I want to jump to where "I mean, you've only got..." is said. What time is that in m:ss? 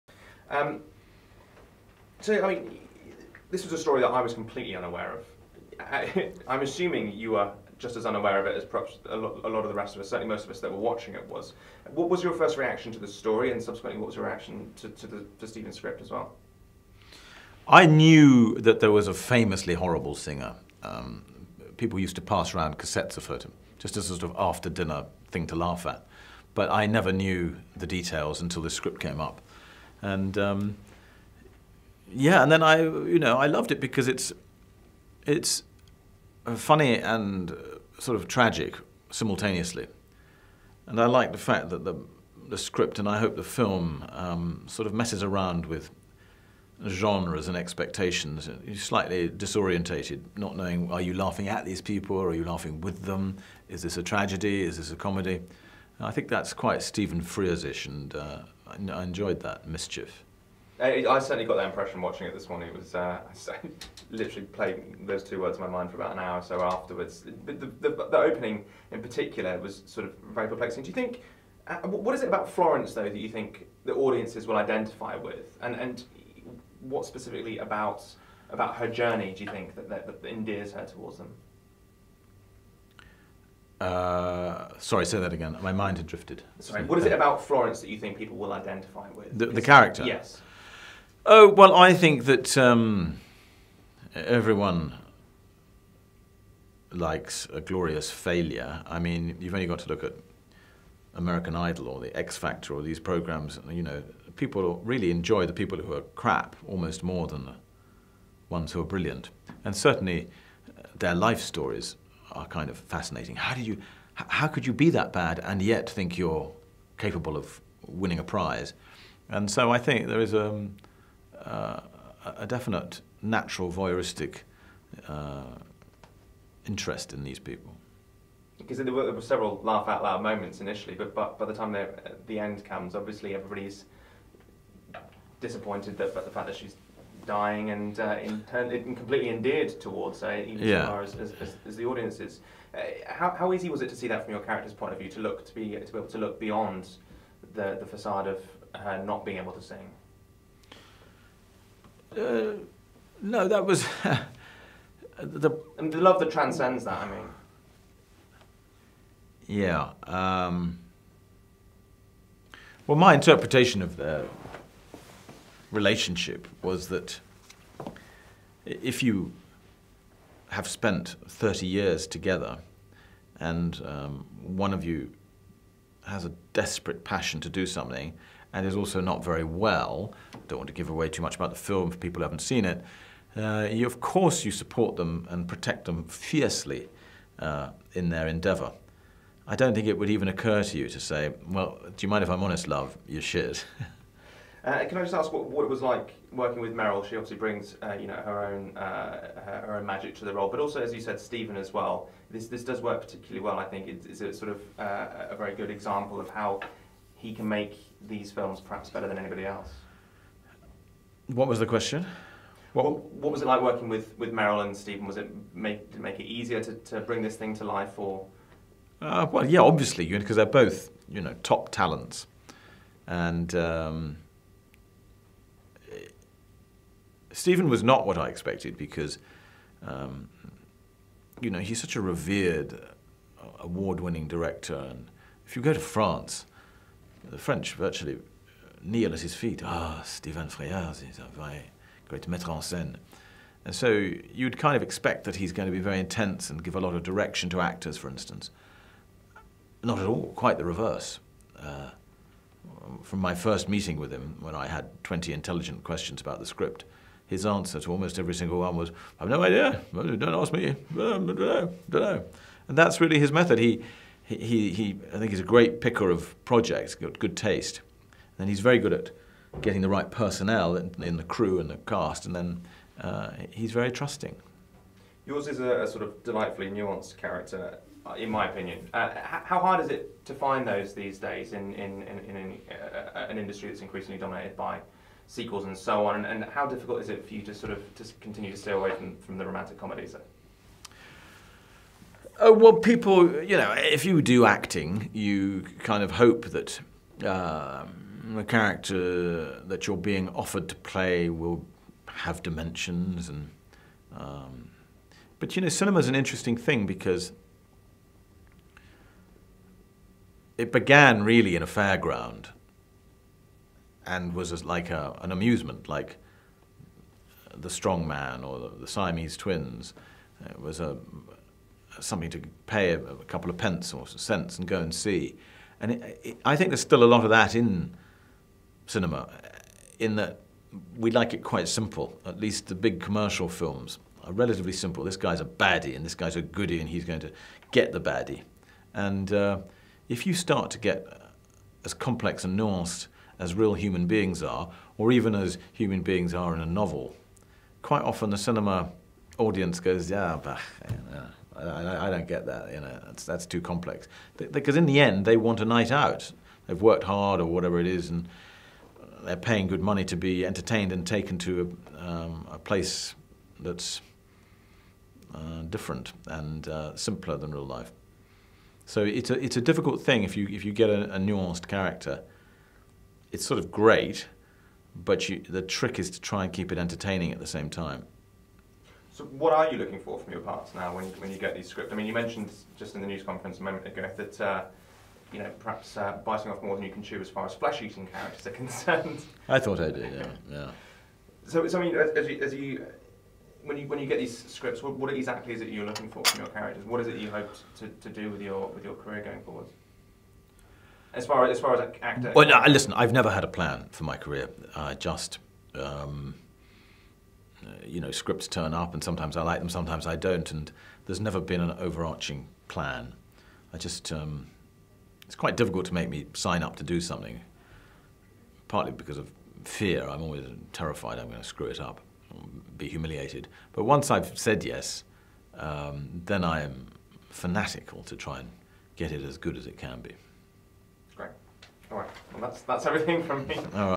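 1:38.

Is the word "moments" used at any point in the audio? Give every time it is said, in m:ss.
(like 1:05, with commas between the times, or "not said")
2:10, 6:23.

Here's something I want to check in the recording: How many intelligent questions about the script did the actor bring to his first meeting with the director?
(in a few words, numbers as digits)
20.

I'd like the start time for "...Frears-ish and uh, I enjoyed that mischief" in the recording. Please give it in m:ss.
0:57.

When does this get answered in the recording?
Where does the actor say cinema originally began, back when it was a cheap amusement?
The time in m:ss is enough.
5:11.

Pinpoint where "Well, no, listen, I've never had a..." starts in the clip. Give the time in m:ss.
6:42.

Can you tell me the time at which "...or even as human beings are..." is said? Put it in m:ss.
5:44.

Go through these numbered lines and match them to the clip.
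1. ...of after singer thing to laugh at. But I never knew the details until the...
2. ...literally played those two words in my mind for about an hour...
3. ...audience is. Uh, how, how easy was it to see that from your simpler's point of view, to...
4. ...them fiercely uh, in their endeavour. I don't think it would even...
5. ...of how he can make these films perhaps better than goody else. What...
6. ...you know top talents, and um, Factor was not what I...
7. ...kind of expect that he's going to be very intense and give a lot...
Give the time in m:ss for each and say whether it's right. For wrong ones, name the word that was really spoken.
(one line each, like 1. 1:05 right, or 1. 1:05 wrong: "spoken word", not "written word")
1. 0:24 wrong: "dinner", not "singer"
2. 1:04 right
3. 2:21 wrong: "character", not "simpler"
4. 3:05 right
5. 3:26 wrong: "anybody", not "goody"
6. 3:41 wrong: "Stephen", not "Factor"
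7. 4:04 right.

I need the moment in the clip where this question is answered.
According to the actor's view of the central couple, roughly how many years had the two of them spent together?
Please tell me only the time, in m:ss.
2:51.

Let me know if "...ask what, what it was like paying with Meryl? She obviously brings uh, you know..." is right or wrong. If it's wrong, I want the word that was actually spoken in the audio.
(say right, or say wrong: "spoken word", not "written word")
wrong: "working", not "paying".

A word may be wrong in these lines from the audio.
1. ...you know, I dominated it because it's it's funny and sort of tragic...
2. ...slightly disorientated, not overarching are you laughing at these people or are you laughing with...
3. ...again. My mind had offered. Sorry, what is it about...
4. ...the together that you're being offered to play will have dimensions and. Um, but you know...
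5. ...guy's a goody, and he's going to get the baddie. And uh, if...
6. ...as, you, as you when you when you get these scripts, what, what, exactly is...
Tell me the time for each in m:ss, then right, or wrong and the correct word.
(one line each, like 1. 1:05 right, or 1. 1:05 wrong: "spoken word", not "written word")
1. 0:32 wrong: "loved", not "dominated"
2. 0:48 wrong: "knowing", not "overarching"
3. 1:25 wrong: "drifted", not "offered"
4. 4:58 wrong: "character", not "together"
5. 5:36 right
6. 6:31 right.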